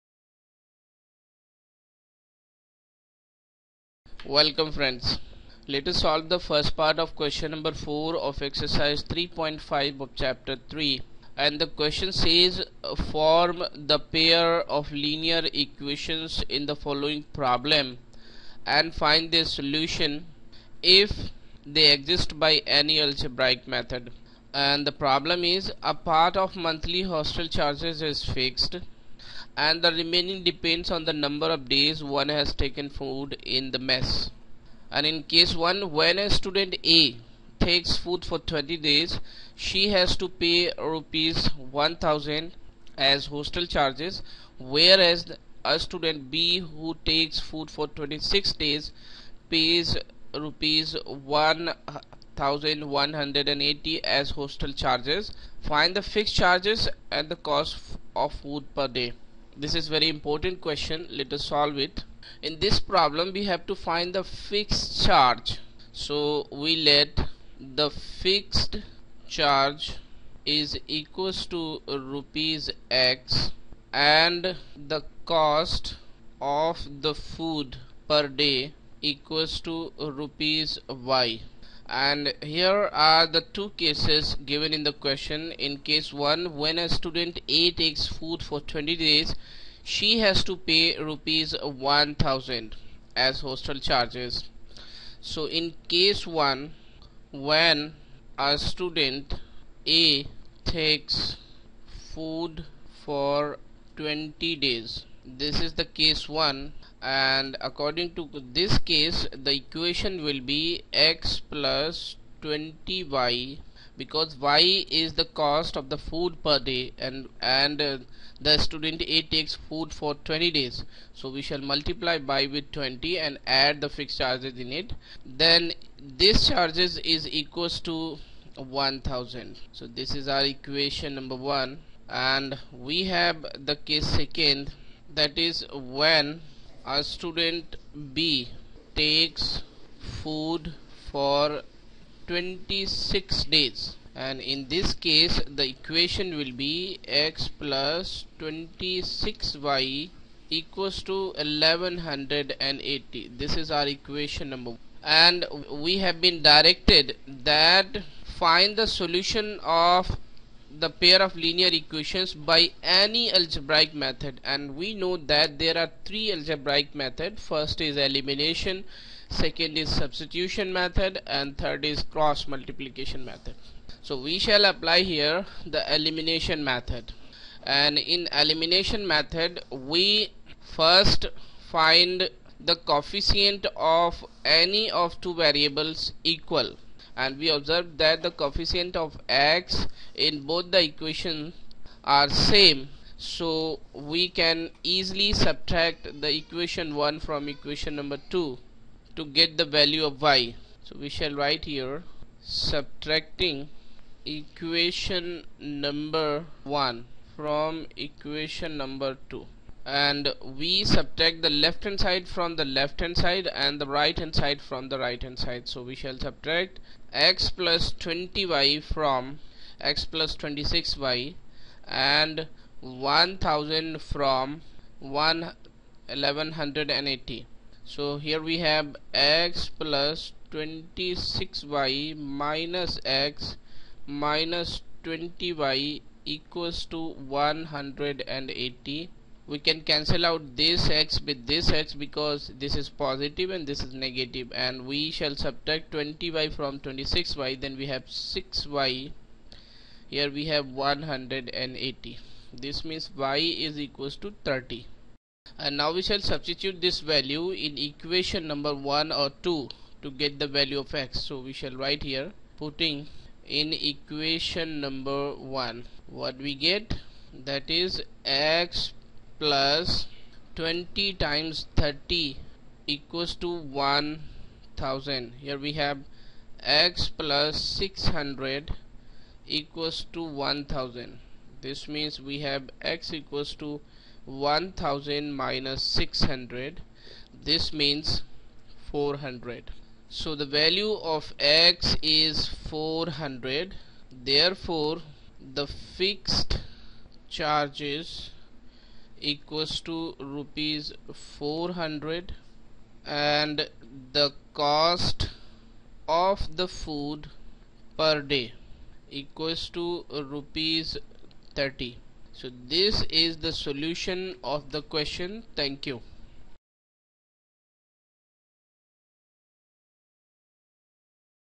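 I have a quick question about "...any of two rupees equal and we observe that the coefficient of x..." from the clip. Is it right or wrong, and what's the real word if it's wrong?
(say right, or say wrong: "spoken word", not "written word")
wrong: "variables", not "rupees".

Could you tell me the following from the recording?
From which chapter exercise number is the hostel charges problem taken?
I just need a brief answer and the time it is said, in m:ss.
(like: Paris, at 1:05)
3.5, at 0:09.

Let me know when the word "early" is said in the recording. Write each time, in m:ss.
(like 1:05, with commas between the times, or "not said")
not said.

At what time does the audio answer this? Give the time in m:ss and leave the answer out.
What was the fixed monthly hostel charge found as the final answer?
5:00.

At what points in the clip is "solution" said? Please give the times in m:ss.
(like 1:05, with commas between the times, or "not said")
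0:19, 2:38, 5:13.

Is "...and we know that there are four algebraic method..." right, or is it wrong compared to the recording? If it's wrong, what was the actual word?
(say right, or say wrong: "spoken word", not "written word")
wrong: "three", not "four".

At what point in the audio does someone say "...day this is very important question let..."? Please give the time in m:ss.
0:58.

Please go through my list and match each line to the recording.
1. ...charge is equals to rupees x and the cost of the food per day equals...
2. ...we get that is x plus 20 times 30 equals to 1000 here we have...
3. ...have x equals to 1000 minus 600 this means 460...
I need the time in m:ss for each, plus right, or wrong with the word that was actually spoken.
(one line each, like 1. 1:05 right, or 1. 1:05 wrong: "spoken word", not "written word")
1. 1:09 right
2. 4:26 right
3. 4:42 wrong: "400", not "460".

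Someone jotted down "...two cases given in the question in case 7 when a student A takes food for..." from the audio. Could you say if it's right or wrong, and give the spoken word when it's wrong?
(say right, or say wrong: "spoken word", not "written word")
wrong: "1", not "7".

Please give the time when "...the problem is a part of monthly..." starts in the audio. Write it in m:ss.
0:24.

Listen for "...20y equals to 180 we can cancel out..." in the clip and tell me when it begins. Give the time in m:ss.
3:55.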